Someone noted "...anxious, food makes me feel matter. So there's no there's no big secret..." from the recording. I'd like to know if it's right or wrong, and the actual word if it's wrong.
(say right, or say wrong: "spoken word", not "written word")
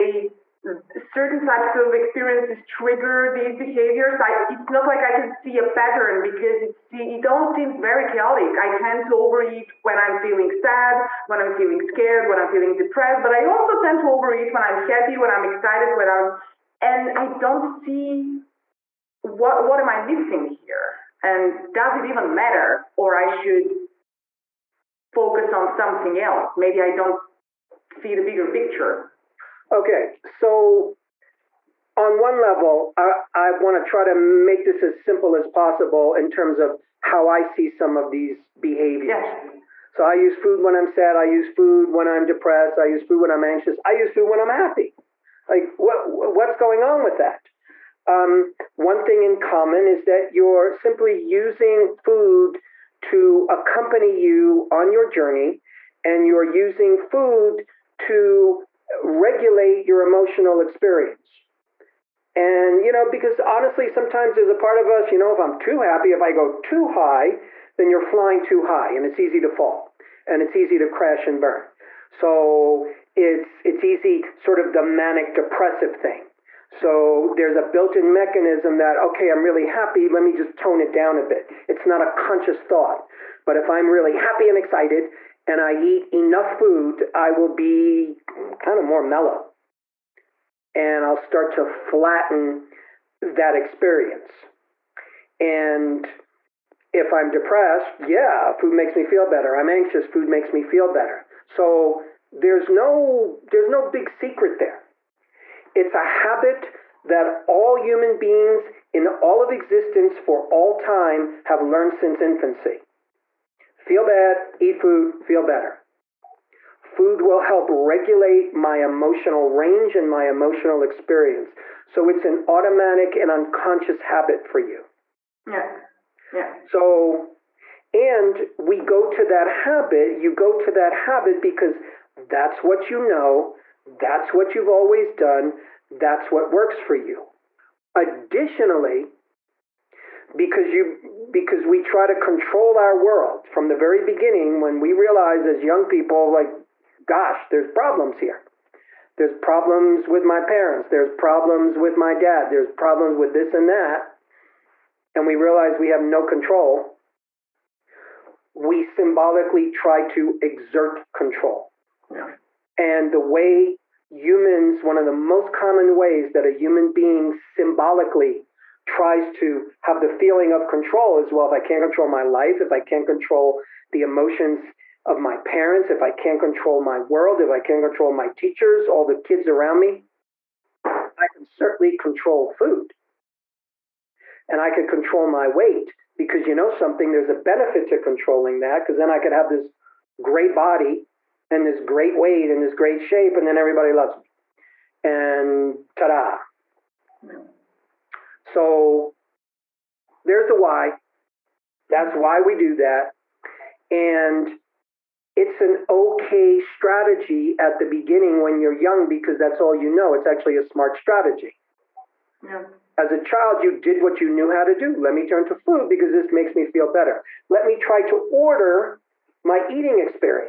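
wrong: "better", not "matter".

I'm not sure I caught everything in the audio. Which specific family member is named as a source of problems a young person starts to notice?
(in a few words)
dad.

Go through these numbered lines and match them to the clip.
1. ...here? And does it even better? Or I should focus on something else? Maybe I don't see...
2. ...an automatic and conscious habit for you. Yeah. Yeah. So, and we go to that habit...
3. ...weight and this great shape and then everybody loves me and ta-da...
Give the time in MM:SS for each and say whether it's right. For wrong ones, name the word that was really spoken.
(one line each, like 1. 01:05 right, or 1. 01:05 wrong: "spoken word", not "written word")
1. 00:20 wrong: "matter", not "better"
2. 02:02 wrong: "unconscious", not "conscious"
3. 03:12 right.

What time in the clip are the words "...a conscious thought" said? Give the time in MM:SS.
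01:22.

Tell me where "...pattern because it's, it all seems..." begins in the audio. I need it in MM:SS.
00:05.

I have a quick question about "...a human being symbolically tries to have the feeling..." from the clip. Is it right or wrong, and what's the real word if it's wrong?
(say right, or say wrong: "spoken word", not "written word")
right.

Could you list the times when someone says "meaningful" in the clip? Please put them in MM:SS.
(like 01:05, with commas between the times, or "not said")
not said.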